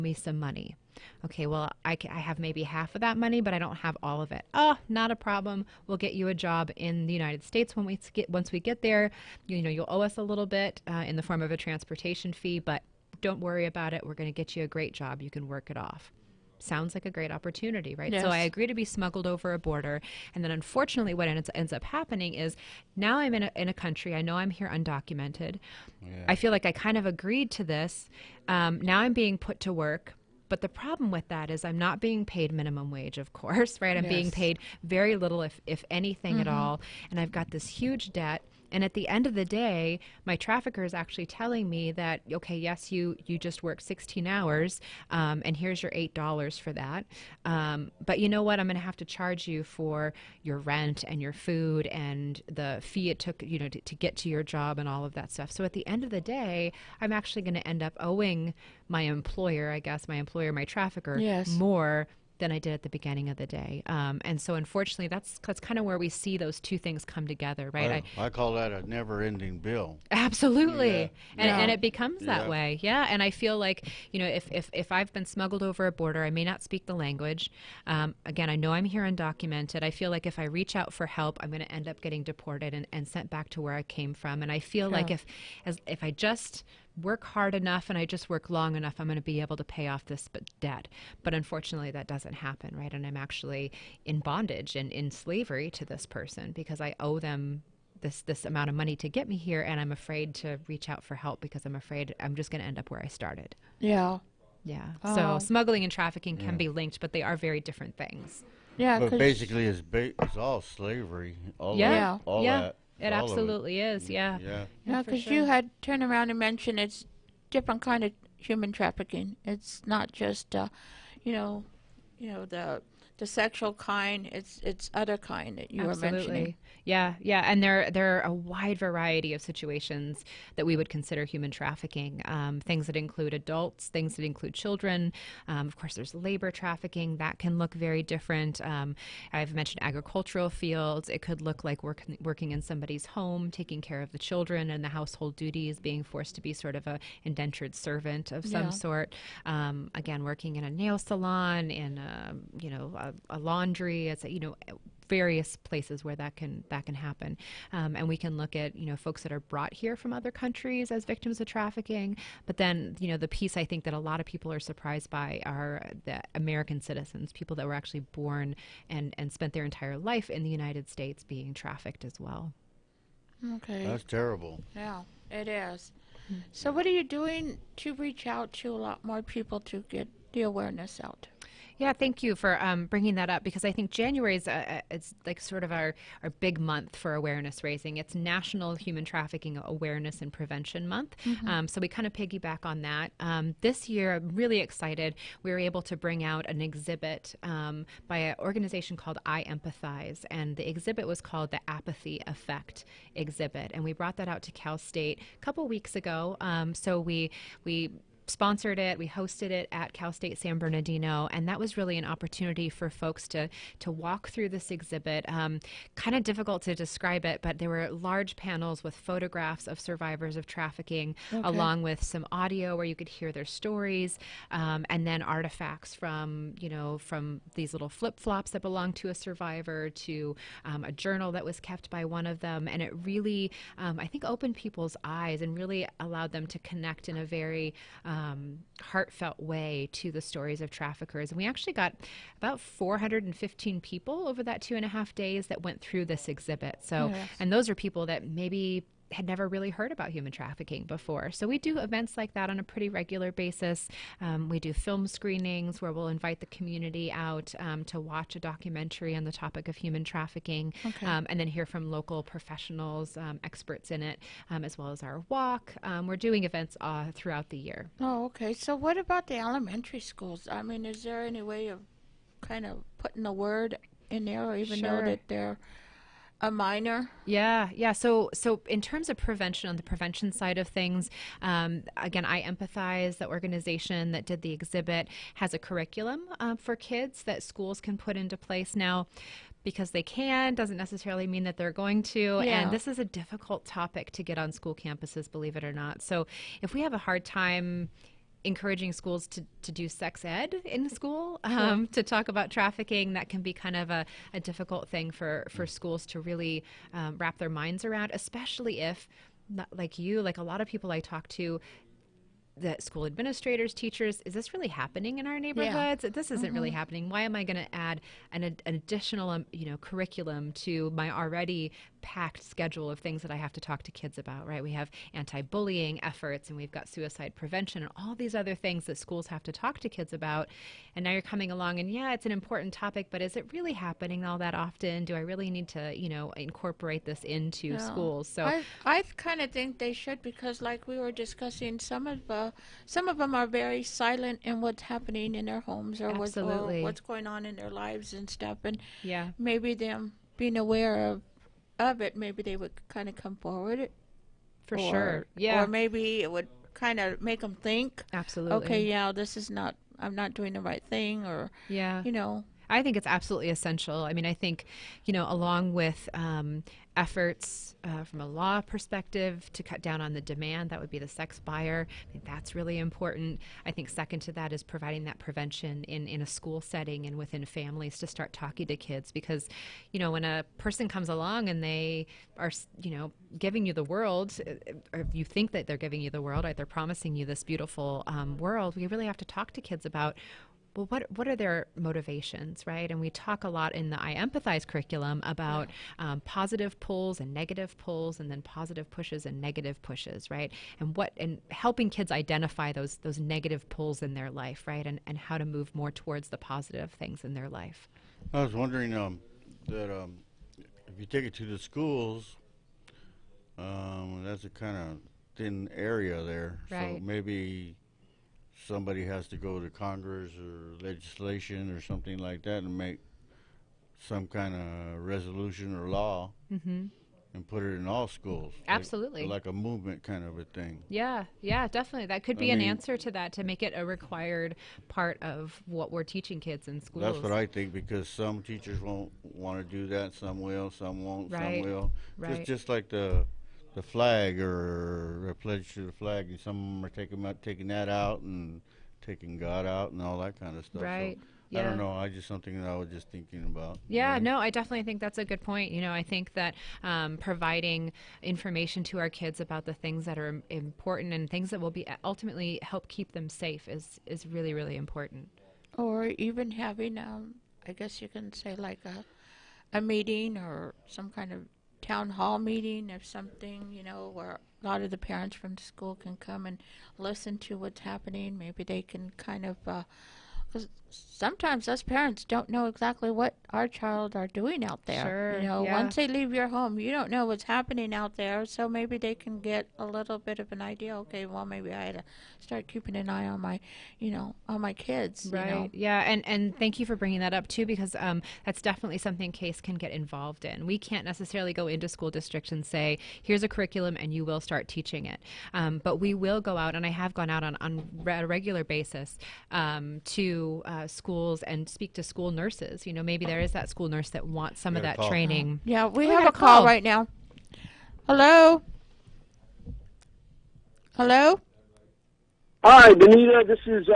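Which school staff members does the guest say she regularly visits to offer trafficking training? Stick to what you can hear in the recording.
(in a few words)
school nurses.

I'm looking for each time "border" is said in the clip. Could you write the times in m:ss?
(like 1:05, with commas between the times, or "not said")
0:19, 1:15.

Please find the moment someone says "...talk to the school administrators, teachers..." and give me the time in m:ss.
5:11.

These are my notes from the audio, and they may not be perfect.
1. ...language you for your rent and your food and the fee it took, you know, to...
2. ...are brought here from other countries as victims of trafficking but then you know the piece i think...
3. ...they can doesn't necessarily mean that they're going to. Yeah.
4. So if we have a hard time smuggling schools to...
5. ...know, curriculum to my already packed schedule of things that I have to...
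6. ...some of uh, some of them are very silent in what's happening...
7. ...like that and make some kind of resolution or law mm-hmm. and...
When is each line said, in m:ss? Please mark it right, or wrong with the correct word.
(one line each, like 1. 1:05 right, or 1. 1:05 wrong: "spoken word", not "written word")
1. 0:49 wrong: "charge", not "language"
2. 2:39 right
3. 4:49 right
4. 4:56 wrong: "encouraging", not "smuggling"
5. 5:19 right
6. 5:41 right
7. 7:02 right.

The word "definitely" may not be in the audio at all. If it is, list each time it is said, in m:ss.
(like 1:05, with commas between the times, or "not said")
7:11, 7:34, 8:18.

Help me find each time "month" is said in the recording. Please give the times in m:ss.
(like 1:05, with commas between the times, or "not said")
3:06, 3:10.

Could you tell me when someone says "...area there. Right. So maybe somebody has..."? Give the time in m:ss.
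6:55.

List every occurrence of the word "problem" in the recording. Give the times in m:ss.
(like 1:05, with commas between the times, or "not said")
0:05, 0:30.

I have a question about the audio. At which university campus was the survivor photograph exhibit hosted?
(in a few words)
Cal State San Bernardino.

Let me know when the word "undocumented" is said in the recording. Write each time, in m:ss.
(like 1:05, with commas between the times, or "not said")
0:24, 1:19.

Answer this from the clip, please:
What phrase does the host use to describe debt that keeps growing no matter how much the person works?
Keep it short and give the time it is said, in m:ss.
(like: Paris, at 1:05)
never-ending bill, at 1:08.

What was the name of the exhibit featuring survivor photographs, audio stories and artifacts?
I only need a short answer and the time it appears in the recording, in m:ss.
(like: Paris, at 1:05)
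Apathy Effect exhibit, at 3:21.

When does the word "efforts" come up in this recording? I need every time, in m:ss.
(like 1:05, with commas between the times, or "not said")
5:26, 6:06.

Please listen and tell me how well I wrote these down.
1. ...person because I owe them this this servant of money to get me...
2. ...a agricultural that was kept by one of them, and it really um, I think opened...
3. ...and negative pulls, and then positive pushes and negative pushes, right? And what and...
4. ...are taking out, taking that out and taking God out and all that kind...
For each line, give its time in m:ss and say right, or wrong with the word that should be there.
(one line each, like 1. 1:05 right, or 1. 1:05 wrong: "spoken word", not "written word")
1. 1:36 wrong: "amount", not "servant"
2. 3:50 wrong: "journal", not "agricultural"
3. 6:37 right
4. 7:26 right.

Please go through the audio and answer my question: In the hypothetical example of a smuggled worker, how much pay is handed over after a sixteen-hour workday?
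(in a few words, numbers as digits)
$8.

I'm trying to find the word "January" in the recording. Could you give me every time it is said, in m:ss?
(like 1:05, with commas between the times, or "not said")
3:03.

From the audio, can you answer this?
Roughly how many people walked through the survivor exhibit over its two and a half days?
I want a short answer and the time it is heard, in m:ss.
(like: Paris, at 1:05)
415, at 4:02.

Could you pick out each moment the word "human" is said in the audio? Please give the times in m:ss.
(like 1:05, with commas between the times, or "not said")
1:58, 2:11, 3:08, 4:10, 4:19.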